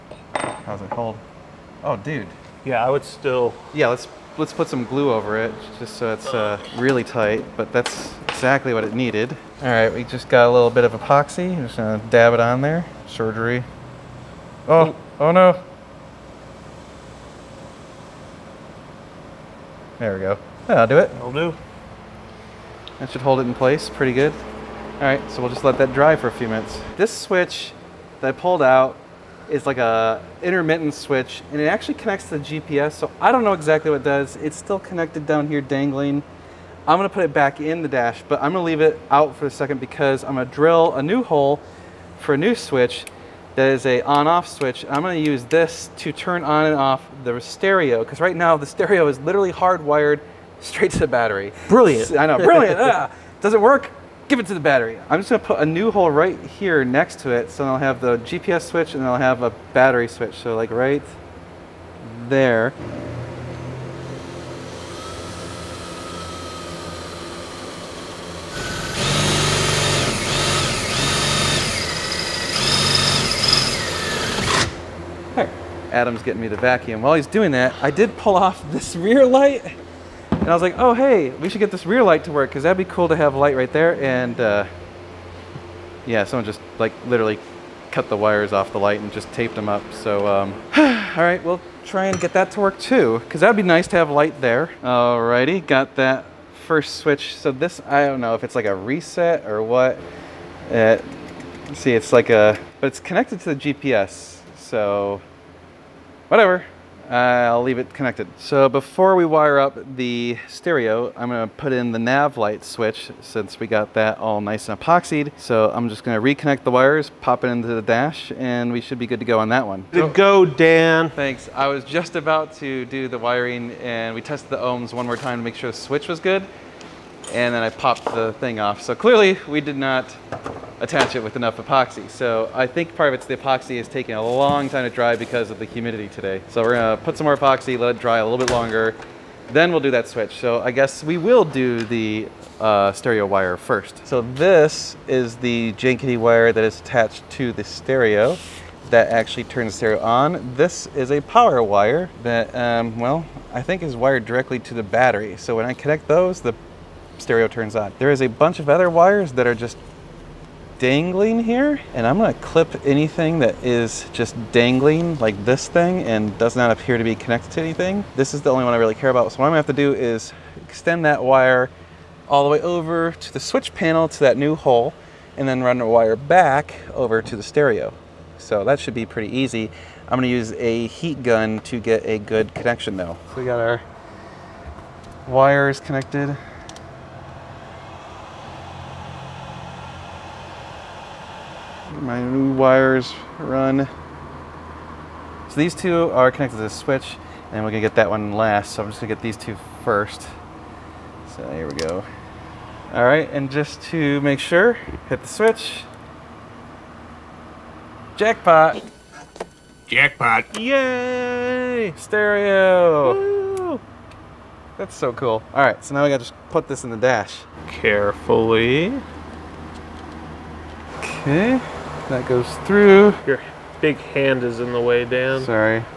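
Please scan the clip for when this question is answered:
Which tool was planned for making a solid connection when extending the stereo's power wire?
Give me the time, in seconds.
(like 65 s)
180 s.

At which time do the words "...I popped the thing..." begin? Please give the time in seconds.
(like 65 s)
127 s.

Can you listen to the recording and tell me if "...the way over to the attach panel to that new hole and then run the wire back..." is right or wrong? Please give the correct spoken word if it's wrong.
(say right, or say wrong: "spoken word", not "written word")
wrong: "switch", not "attach".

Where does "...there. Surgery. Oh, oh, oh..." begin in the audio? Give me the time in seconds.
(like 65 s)
12 s.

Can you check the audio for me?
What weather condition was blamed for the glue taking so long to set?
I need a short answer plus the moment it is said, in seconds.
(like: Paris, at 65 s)
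humidity, at 135 s.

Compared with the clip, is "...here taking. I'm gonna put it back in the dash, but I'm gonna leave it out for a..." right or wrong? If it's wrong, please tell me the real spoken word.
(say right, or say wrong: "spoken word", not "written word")
wrong: "dangling", not "taking".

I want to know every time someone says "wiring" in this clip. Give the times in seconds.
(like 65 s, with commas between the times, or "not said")
123 s.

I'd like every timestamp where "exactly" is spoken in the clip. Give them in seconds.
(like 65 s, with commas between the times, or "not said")
8 s, 33 s.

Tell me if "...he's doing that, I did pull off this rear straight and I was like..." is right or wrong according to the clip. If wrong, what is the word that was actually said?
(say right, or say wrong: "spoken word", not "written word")
wrong: "light", not "straight".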